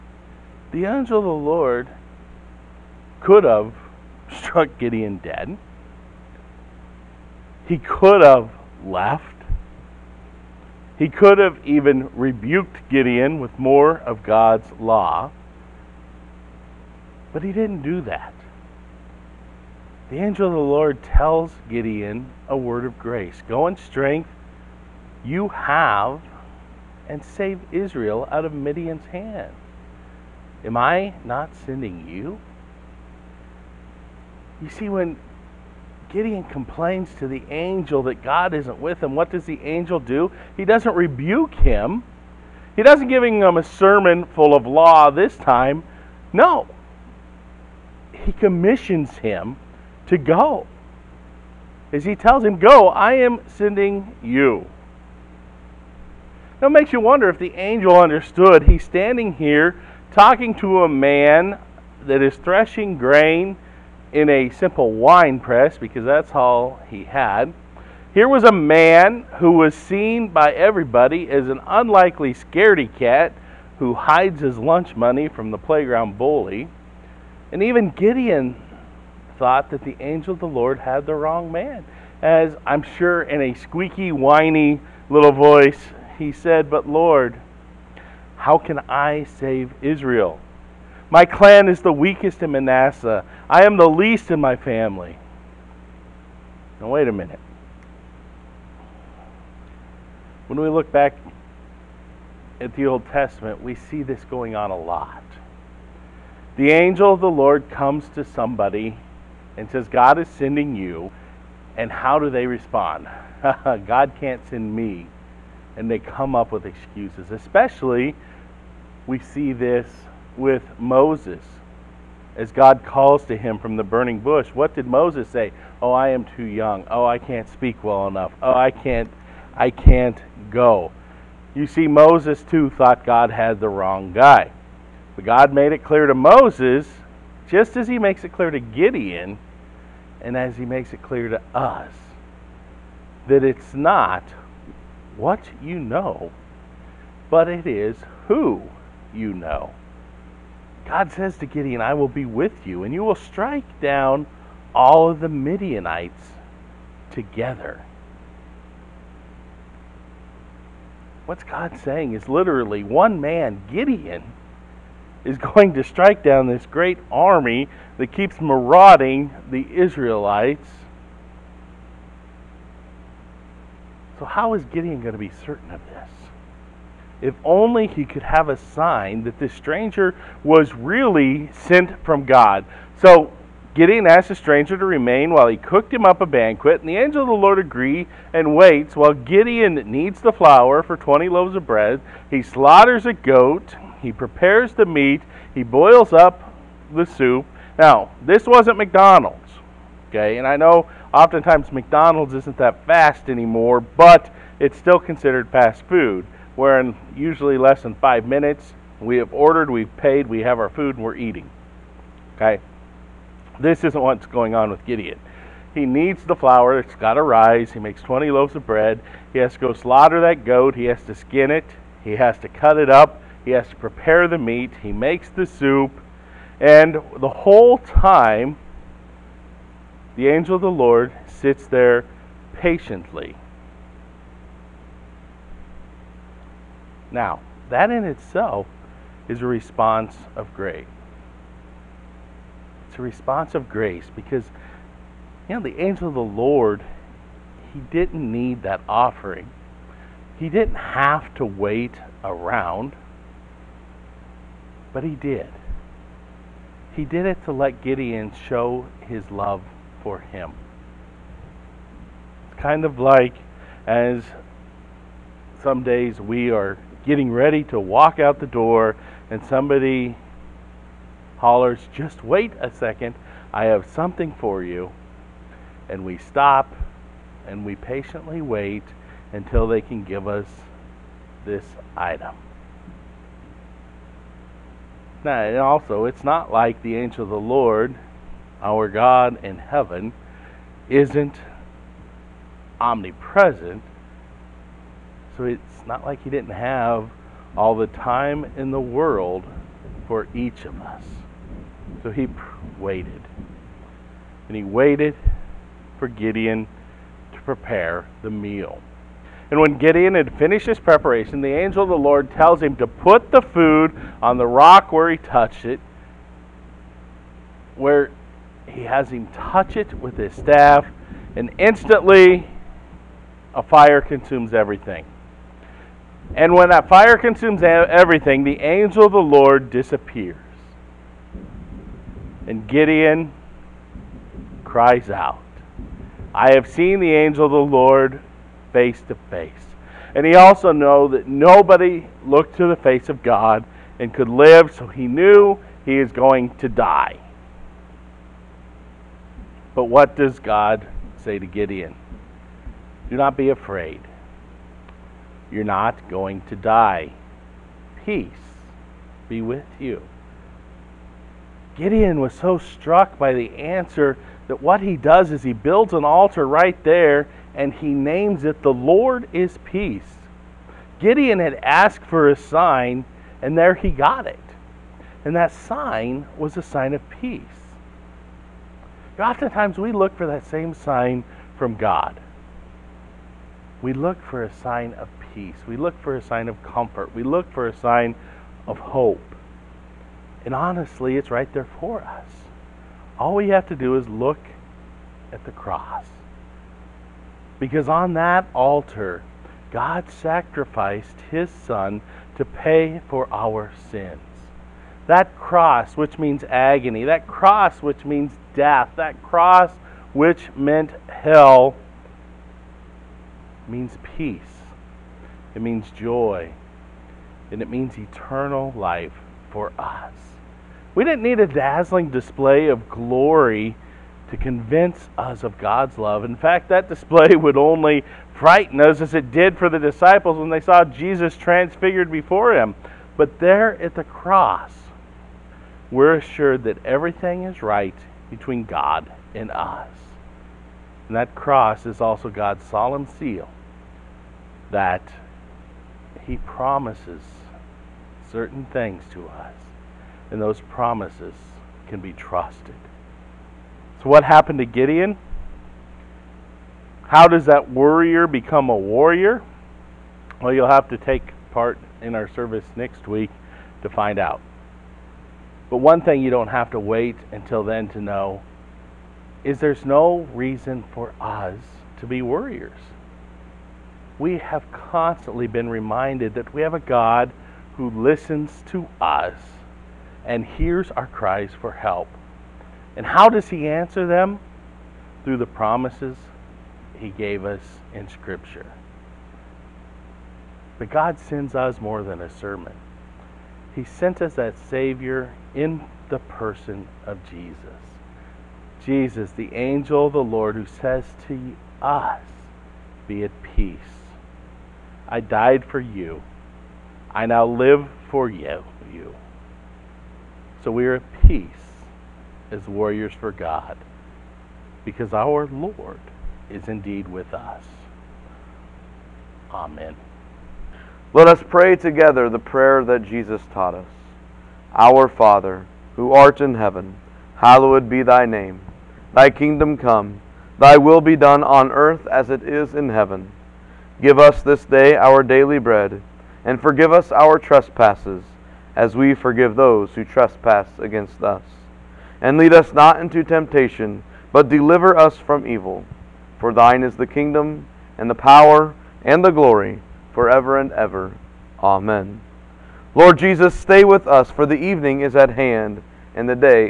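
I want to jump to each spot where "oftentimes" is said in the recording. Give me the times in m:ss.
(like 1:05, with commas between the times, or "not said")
3:21, 6:19.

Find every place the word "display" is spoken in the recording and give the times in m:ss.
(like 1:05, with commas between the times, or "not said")
7:02, 7:06.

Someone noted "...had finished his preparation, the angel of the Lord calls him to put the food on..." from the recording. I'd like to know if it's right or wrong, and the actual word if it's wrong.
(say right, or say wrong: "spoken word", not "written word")
wrong: "tells", not "calls".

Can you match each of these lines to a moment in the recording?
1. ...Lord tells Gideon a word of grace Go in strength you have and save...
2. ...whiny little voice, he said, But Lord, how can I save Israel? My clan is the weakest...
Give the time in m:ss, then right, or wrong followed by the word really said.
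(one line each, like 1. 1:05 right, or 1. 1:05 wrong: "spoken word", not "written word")
1. 0:20 right
2. 1:24 right.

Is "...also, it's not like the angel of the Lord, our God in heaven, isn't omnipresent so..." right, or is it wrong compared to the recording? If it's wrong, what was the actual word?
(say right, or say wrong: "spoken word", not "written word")
right.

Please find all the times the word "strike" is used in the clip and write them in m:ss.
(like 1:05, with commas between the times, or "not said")
2:33, 2:45.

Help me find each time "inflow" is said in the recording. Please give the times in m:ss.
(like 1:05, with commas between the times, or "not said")
not said.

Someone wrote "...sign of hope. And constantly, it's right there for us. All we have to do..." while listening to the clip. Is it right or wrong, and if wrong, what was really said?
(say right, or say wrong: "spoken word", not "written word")
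wrong: "honestly", not "constantly".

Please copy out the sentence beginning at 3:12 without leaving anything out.
He slaughters a goat, he prepares the meat, he boils up the soup.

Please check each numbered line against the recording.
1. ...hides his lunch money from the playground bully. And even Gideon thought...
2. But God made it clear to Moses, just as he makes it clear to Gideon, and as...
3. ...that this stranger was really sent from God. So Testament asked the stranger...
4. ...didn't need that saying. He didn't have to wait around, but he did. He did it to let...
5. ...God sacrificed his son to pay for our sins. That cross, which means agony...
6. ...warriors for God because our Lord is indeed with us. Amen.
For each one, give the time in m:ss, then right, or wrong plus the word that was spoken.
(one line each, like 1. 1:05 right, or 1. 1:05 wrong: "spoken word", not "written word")
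1. 1:13 right
2. 2:15 right
3. 2:59 wrong: "Gideon", not "Testament"
4. 4:07 wrong: "offering", not "saying"
5. 6:39 right
6. 8:32 right.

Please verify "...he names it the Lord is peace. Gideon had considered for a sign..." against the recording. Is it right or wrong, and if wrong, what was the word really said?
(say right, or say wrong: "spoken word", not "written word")
wrong: "asked", not "considered".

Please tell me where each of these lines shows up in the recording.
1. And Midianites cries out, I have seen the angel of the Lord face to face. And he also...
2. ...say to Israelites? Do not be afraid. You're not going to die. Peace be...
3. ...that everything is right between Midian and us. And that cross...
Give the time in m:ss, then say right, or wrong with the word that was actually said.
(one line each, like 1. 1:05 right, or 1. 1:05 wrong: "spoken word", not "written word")
1. 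5:32 wrong: "Gideon", not "Midianites"
2. 5:51 wrong: "Gideon", not "Israelites"
3. 7:16 wrong: "God", not "Midian".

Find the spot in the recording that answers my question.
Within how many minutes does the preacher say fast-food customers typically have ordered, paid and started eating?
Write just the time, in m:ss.
3:27.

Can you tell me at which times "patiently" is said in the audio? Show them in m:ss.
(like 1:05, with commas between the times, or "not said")
3:52, 4:37.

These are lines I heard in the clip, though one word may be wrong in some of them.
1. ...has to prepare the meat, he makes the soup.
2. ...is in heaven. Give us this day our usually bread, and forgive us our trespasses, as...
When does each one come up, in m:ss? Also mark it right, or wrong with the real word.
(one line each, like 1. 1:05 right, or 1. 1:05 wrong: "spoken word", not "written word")
1. 3:43 right
2. 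8:52 wrong: "daily", not "usually".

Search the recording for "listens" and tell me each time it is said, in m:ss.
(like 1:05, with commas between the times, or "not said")
7:57.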